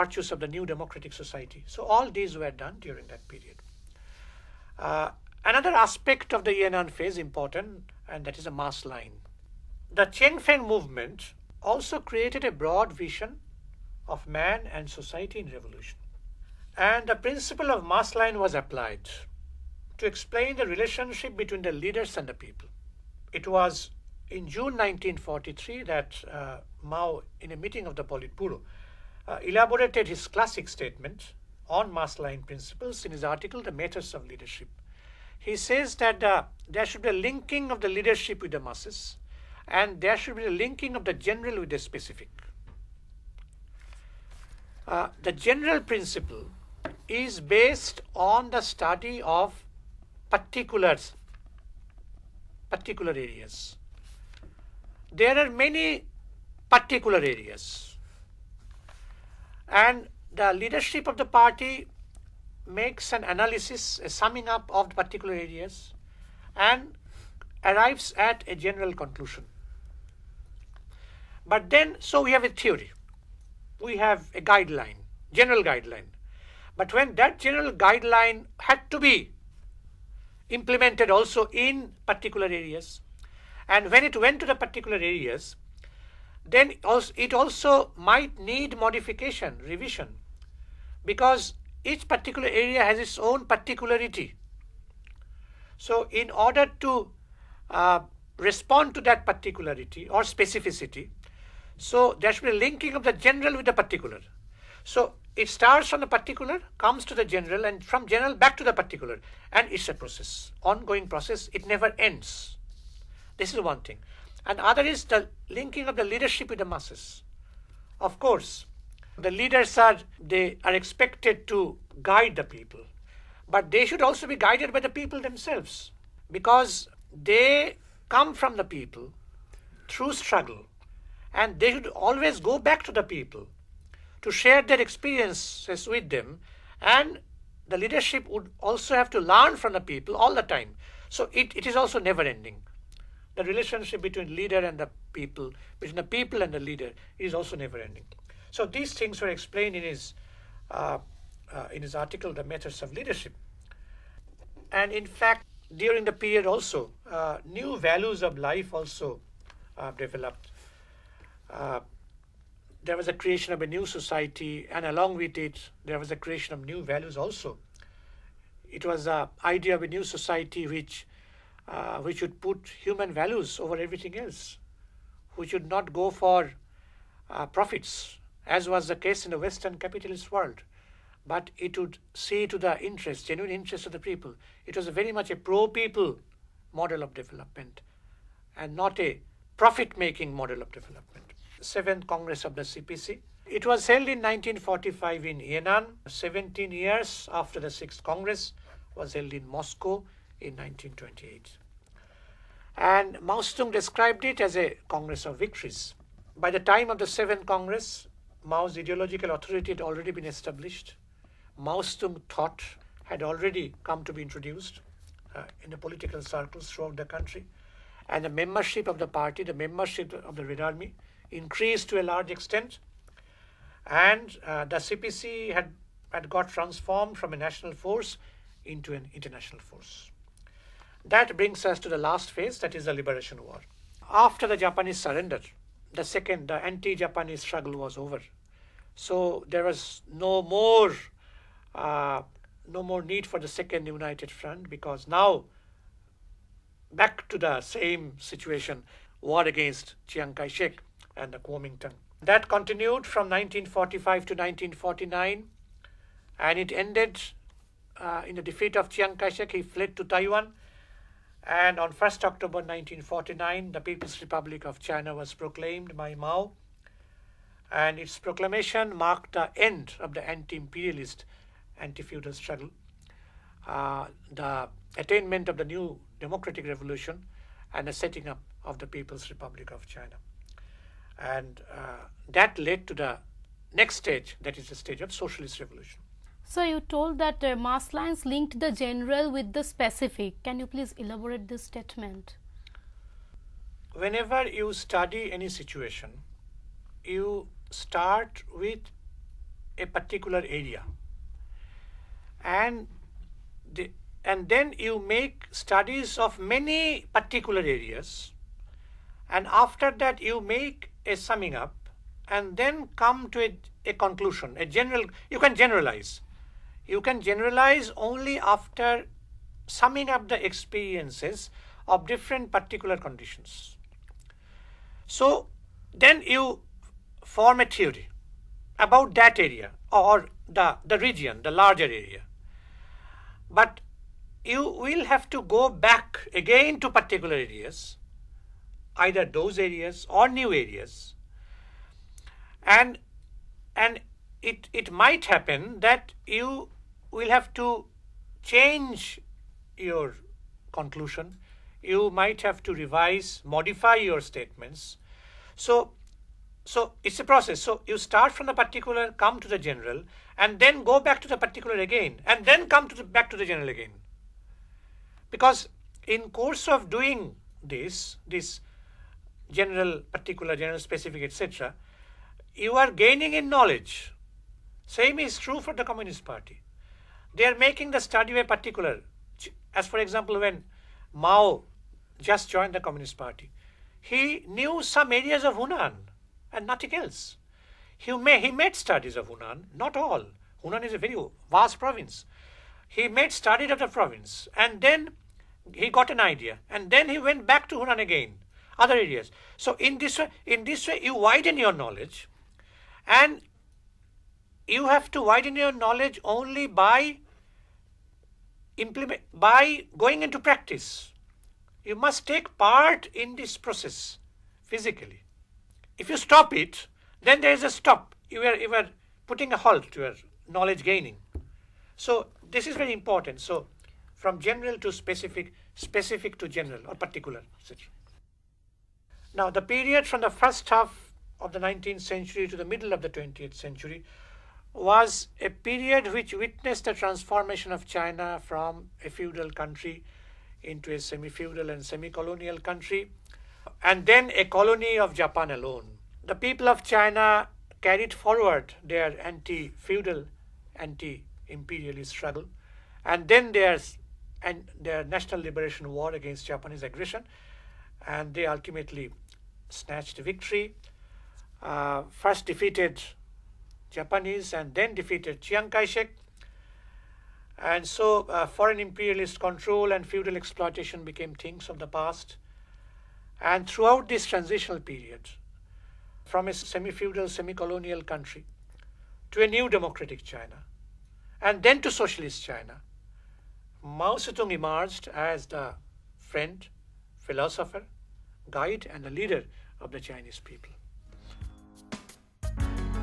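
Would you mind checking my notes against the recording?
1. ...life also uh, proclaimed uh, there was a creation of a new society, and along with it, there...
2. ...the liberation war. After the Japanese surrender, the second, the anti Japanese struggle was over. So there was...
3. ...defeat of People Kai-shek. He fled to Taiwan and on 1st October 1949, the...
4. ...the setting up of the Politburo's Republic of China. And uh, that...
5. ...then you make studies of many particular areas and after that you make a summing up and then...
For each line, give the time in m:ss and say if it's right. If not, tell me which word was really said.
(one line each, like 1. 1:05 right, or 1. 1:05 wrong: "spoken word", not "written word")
1. 2:38 wrong: "developed", not "proclaimed"
2. 3:52 right
3. 4:18 wrong: "Chiang", not "People"
4. 4:37 wrong: "People", not "Politburo"
5. 5:04 right.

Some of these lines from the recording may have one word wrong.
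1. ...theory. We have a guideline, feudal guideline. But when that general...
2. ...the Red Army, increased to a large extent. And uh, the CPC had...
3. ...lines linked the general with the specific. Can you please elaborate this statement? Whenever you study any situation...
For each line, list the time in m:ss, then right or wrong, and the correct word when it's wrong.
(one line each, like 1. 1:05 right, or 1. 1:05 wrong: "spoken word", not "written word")
1. 1:12 wrong: "general", not "feudal"
2. 3:40 right
3. 4:47 right.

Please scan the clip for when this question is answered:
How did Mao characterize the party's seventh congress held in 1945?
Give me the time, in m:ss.
3:24.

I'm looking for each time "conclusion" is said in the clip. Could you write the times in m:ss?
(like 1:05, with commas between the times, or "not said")
1:08, 5:13, 5:50.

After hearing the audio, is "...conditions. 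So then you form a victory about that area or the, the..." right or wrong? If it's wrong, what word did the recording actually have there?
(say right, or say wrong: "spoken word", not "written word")
wrong: "theory", not "victory".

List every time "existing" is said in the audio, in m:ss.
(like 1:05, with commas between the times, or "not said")
not said.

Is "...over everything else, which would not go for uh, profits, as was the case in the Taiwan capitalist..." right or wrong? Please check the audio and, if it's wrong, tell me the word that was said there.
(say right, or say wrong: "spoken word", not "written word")
wrong: "Western", not "Taiwan".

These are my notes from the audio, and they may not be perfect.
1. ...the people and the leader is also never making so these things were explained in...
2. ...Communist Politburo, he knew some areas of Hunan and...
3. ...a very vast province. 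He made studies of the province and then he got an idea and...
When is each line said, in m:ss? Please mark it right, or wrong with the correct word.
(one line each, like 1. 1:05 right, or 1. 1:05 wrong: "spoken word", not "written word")
1. 2:25 wrong: "ending", not "making"
2. 6:22 wrong: "Party", not "Politburo"
3. 6:30 right.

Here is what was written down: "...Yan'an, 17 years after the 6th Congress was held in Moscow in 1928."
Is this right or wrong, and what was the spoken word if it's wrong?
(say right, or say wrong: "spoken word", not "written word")
right.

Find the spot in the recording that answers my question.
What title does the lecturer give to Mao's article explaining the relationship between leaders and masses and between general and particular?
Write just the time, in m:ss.
0:33.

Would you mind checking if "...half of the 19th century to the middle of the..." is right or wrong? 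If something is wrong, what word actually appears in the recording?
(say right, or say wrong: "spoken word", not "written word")
right.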